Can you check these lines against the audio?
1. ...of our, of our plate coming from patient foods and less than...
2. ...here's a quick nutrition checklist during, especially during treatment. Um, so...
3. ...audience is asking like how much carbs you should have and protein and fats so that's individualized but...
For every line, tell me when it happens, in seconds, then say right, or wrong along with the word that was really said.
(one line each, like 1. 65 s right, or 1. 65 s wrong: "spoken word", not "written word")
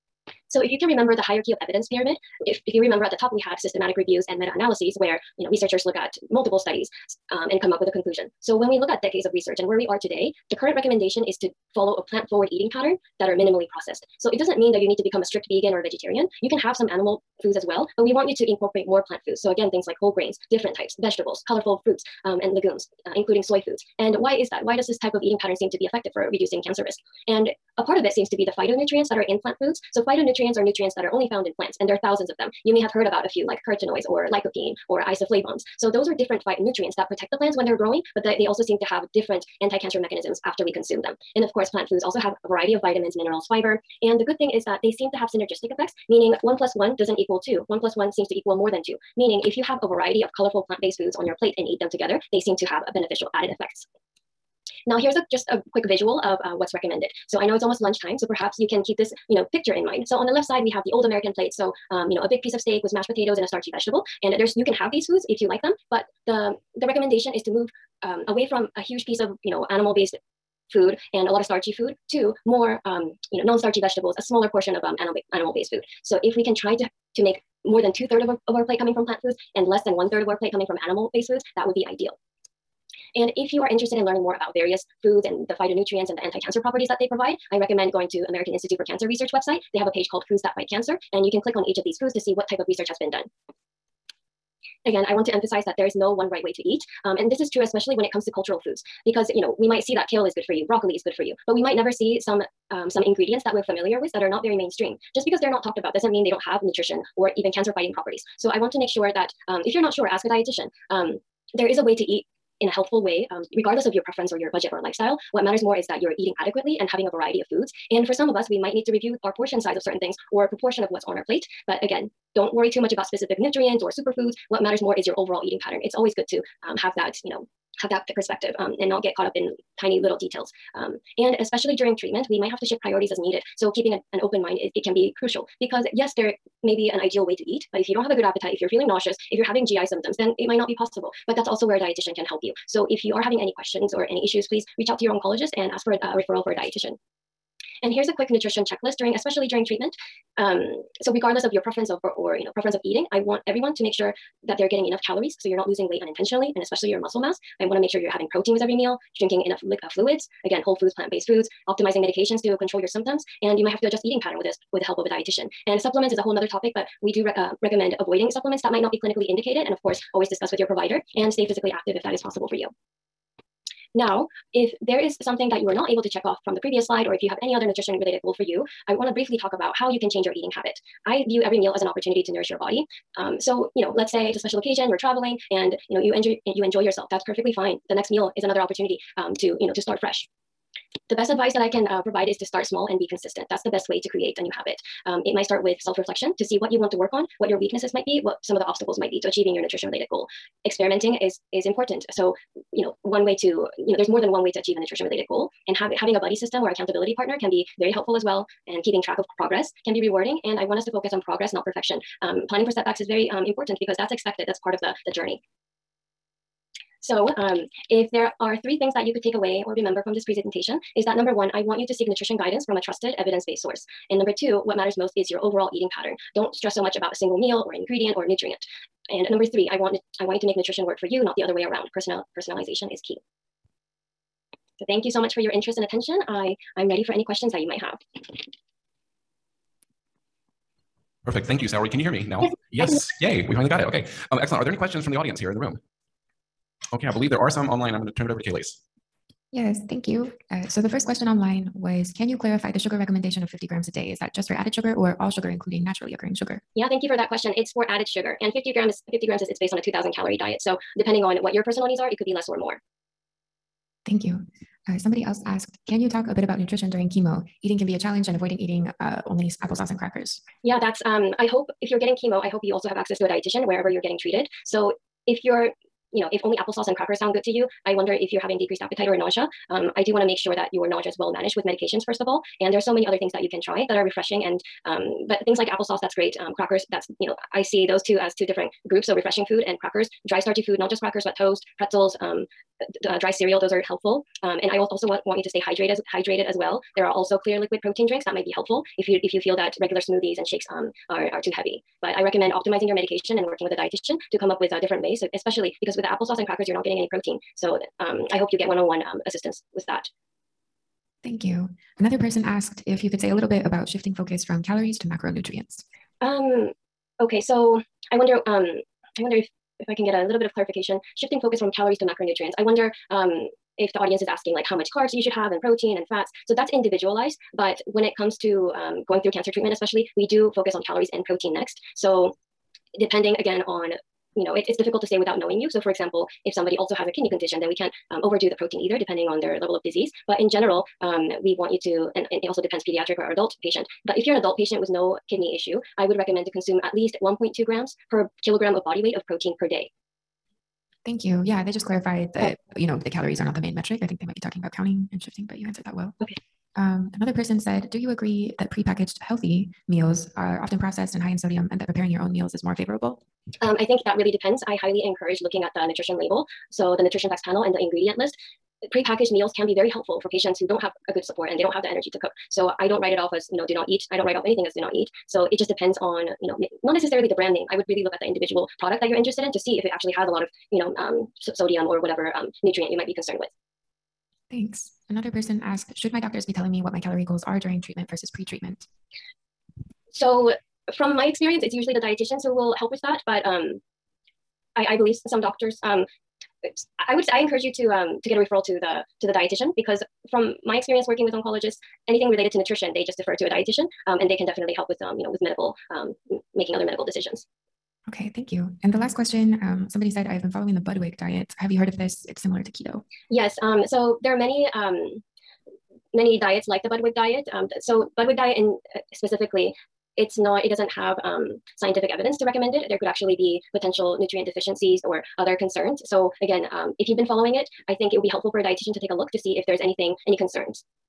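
1. 78 s wrong: "plant", not "patient"
2. 147 s right
3. 323 s right.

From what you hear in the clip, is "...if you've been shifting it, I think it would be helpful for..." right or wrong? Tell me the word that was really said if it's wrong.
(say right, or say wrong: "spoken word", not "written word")
wrong: "following", not "shifting".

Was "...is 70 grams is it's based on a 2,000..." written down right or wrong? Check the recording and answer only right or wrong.
wrong.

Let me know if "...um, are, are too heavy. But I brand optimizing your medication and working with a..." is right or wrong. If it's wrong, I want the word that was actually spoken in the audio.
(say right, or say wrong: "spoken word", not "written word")
wrong: "recommend", not "brand".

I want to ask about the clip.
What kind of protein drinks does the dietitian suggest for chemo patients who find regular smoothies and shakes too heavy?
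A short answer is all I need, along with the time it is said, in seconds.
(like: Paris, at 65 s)
clear liquid protein drinks, at 297 s.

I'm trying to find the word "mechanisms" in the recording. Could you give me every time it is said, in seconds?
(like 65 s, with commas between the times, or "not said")
39 s.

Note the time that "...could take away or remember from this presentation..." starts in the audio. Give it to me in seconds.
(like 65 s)
219 s.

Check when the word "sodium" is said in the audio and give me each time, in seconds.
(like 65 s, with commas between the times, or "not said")
361 s, 381 s.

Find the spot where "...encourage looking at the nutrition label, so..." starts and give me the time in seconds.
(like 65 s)
365 s.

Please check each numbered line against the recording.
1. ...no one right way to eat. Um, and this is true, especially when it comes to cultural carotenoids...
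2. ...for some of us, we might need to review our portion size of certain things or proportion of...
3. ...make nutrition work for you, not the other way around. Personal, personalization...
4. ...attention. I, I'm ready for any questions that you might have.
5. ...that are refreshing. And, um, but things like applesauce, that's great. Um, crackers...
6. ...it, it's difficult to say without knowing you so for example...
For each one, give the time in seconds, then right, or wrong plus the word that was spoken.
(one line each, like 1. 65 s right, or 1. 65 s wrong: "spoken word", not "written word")
1. 95 s wrong: "foods", not "carotenoids"
2. 118 s right
3. 230 s right
4. 235 s right
5. 283 s right
6. 334 s right.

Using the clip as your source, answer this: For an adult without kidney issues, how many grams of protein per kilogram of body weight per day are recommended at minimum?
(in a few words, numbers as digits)
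1.2.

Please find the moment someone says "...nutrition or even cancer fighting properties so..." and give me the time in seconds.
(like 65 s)
106 s.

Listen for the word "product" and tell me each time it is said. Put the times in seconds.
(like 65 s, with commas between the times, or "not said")
378 s.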